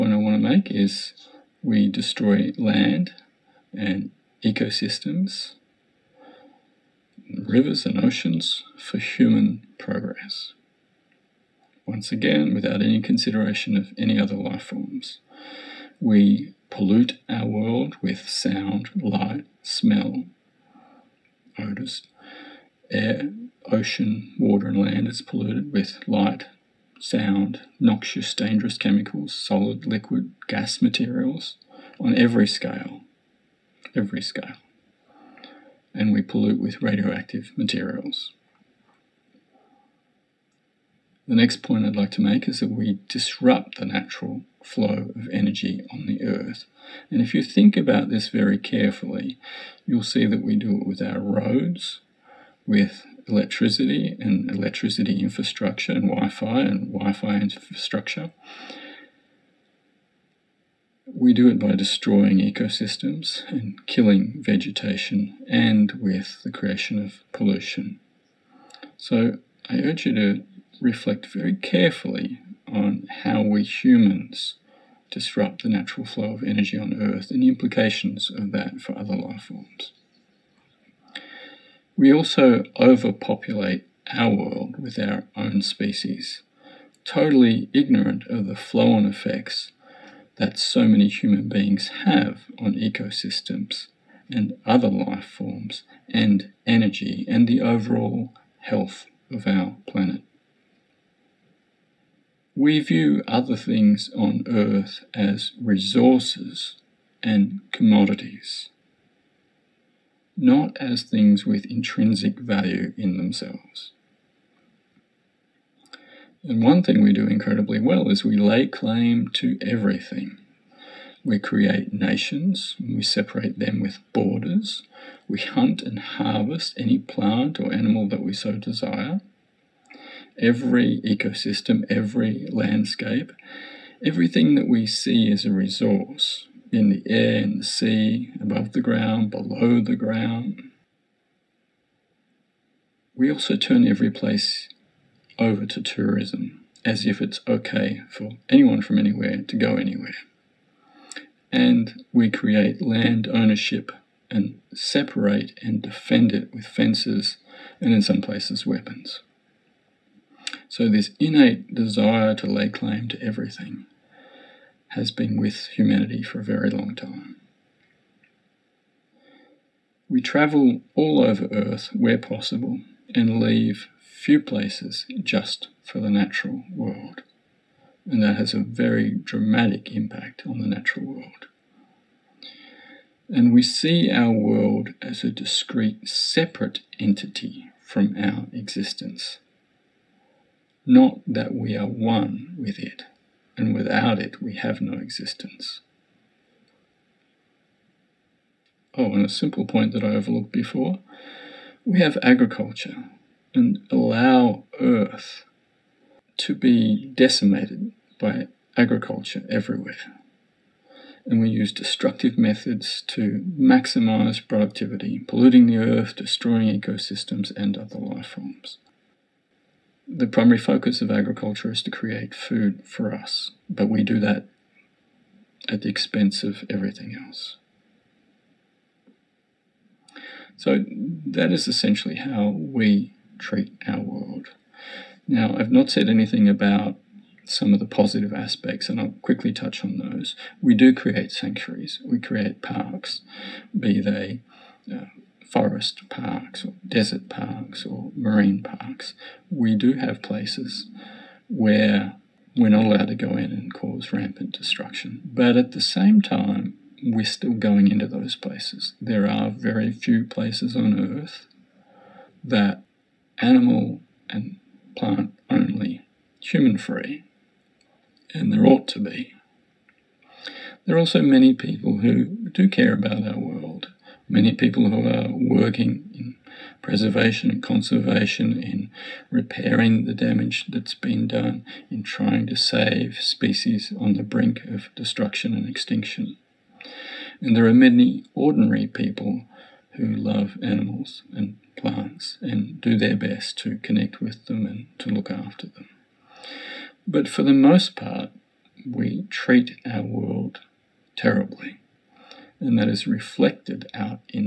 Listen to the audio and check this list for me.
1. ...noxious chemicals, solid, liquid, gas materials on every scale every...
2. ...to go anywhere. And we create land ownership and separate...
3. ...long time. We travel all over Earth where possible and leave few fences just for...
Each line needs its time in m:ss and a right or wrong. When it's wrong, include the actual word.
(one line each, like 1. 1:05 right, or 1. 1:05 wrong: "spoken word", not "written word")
1. 0:28 wrong: "dangerous", not "noxious"
2. 2:29 right
3. 2:46 wrong: "places", not "fences".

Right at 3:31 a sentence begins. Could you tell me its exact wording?
And we use destructive methods to maximize productivity, polluting the earth, destroying ecosystems, and other life forms.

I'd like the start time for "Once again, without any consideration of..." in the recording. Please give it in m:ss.
0:11.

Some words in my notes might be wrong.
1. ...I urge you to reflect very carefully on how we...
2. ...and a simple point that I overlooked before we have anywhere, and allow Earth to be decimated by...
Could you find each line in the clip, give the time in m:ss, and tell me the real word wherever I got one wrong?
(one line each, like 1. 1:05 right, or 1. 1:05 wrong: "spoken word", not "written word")
1. 1:09 right
2. 3:19 wrong: "agriculture", not "anywhere".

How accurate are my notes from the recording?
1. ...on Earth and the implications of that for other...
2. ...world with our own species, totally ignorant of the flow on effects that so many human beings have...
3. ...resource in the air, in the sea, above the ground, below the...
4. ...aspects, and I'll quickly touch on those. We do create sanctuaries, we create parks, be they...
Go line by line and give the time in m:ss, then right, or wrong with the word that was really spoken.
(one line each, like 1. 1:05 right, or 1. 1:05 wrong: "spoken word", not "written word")
1. 1:16 right
2. 1:24 right
3. 2:15 right
4. 3:58 right.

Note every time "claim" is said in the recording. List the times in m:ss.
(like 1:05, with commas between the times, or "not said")
1:58, 2:42.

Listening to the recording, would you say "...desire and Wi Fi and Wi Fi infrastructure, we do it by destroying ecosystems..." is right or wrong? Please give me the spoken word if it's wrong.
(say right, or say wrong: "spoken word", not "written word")
wrong: "infrastructure", not "desire".